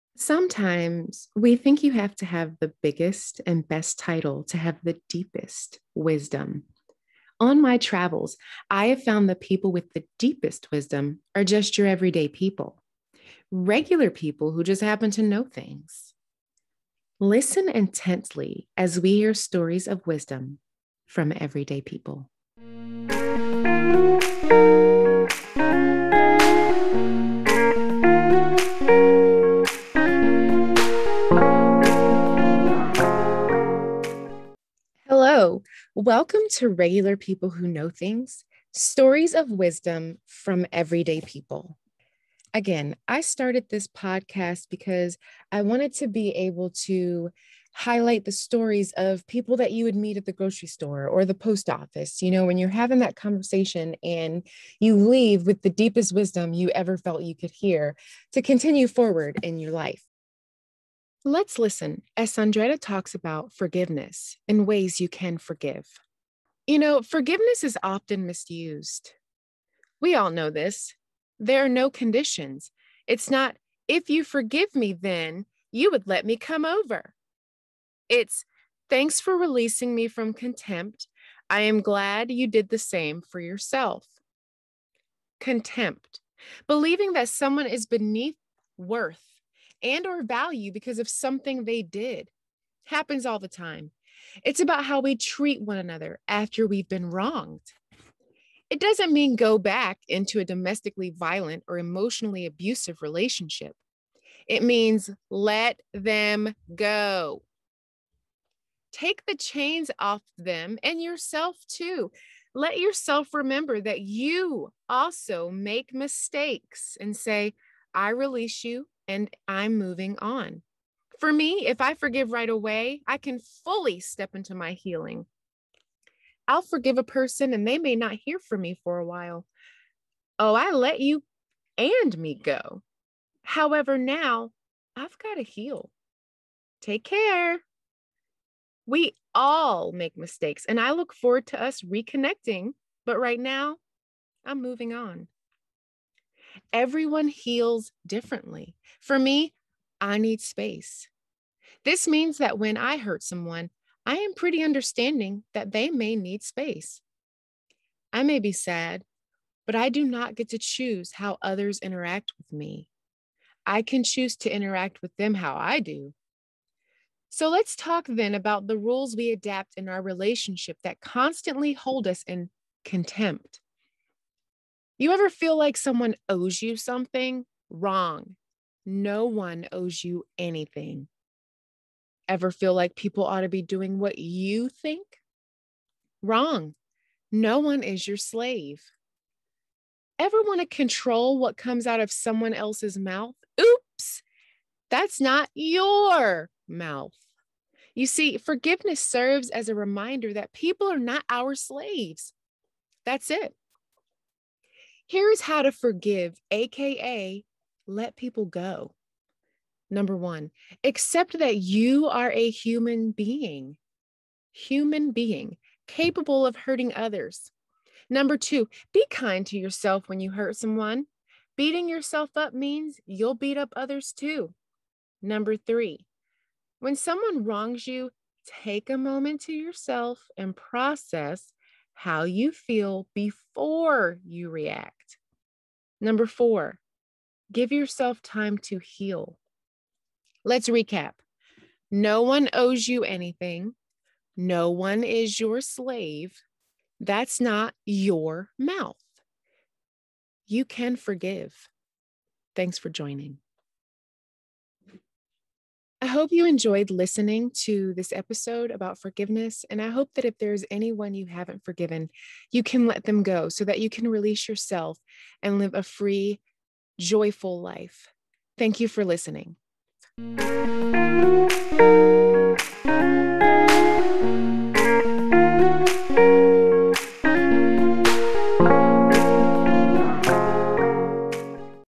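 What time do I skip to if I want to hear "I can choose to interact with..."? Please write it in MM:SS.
02:43.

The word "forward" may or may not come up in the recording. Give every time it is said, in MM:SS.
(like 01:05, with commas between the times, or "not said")
00:58, 02:21.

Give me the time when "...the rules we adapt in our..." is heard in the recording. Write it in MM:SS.
02:48.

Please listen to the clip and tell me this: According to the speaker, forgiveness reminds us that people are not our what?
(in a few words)
Slaves.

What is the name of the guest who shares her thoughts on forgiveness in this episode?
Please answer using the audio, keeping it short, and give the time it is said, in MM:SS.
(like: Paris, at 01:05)
Saundretta, at 01:02.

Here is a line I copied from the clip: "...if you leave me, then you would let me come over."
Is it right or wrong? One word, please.
wrong.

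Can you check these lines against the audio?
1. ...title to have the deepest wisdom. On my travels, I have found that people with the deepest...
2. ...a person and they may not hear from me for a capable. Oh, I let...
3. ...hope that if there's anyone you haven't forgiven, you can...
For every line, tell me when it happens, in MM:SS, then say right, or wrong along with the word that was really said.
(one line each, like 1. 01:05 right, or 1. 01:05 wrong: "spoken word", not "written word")
1. 00:03 right
2. 02:06 wrong: "while", not "capable"
3. 04:19 right.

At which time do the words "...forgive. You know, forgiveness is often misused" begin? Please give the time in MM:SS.
01:05.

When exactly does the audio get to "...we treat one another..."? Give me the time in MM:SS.
01:34.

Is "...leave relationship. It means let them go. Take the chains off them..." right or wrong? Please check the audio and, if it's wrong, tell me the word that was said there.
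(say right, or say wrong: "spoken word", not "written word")
wrong: "abusive", not "leave".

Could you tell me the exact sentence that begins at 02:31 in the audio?
This means that when I hurt someone, I am pretty understanding that they may need space.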